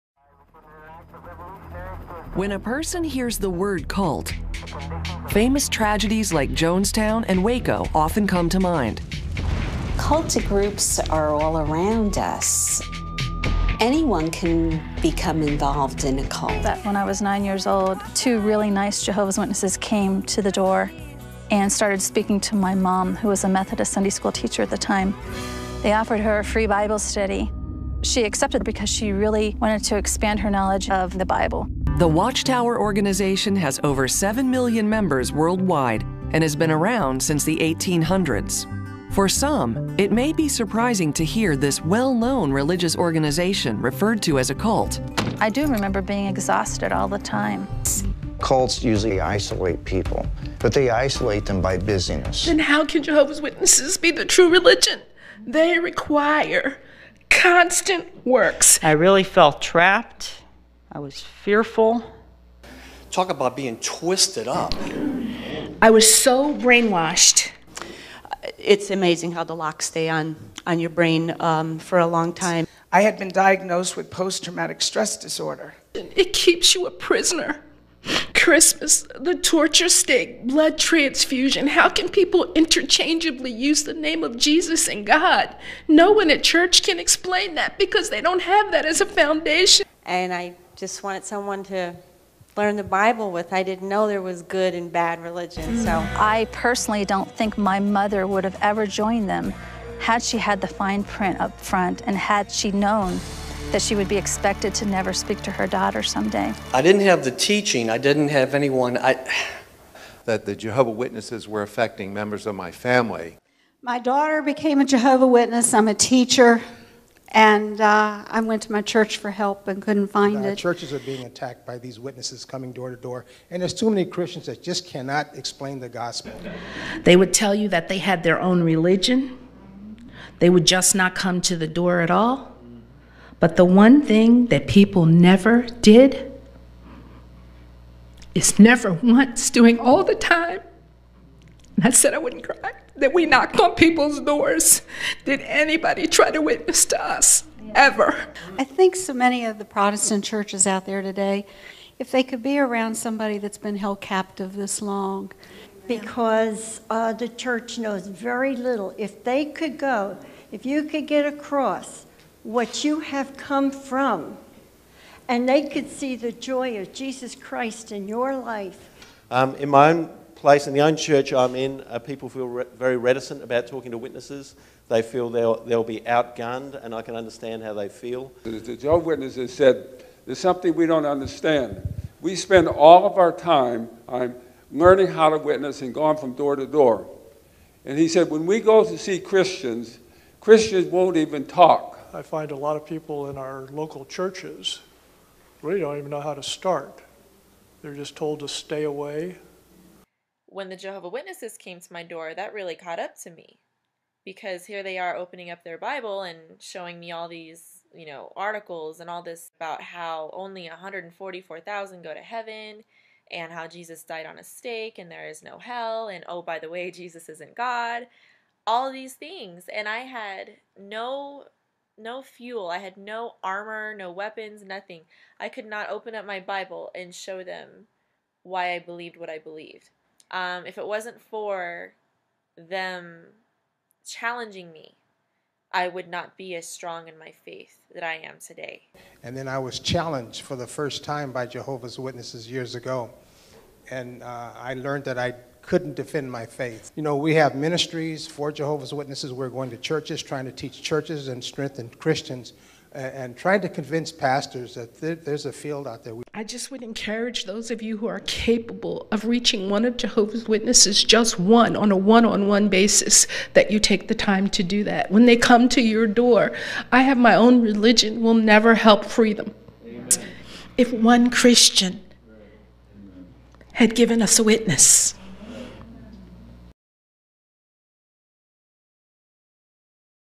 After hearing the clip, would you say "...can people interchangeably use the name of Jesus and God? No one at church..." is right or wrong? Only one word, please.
right.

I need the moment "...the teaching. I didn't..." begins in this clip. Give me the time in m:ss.
1:47.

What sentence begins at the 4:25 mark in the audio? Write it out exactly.
When they come to your door, I have my own religion, will never help free them.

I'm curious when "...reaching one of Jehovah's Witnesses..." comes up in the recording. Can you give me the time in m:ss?
4:19.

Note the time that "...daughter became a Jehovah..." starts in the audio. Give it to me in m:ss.
1:53.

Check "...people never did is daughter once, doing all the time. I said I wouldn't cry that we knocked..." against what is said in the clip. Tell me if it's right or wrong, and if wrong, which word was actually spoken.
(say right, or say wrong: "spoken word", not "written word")
wrong: "never", not "daughter".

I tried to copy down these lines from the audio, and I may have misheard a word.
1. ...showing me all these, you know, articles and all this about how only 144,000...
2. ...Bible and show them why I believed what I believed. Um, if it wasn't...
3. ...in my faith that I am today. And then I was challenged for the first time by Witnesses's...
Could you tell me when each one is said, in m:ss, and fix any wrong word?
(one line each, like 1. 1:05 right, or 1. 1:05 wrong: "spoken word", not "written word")
1. 3:26 right
2. 3:46 right
3. 3:57 wrong: "Jehovah", not "Witnesses".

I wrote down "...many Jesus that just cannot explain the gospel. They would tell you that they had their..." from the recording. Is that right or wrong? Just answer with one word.
wrong.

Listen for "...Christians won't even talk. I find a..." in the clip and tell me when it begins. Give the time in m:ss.
3:10.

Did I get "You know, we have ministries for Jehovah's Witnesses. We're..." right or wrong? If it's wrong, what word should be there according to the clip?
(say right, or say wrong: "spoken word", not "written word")
right.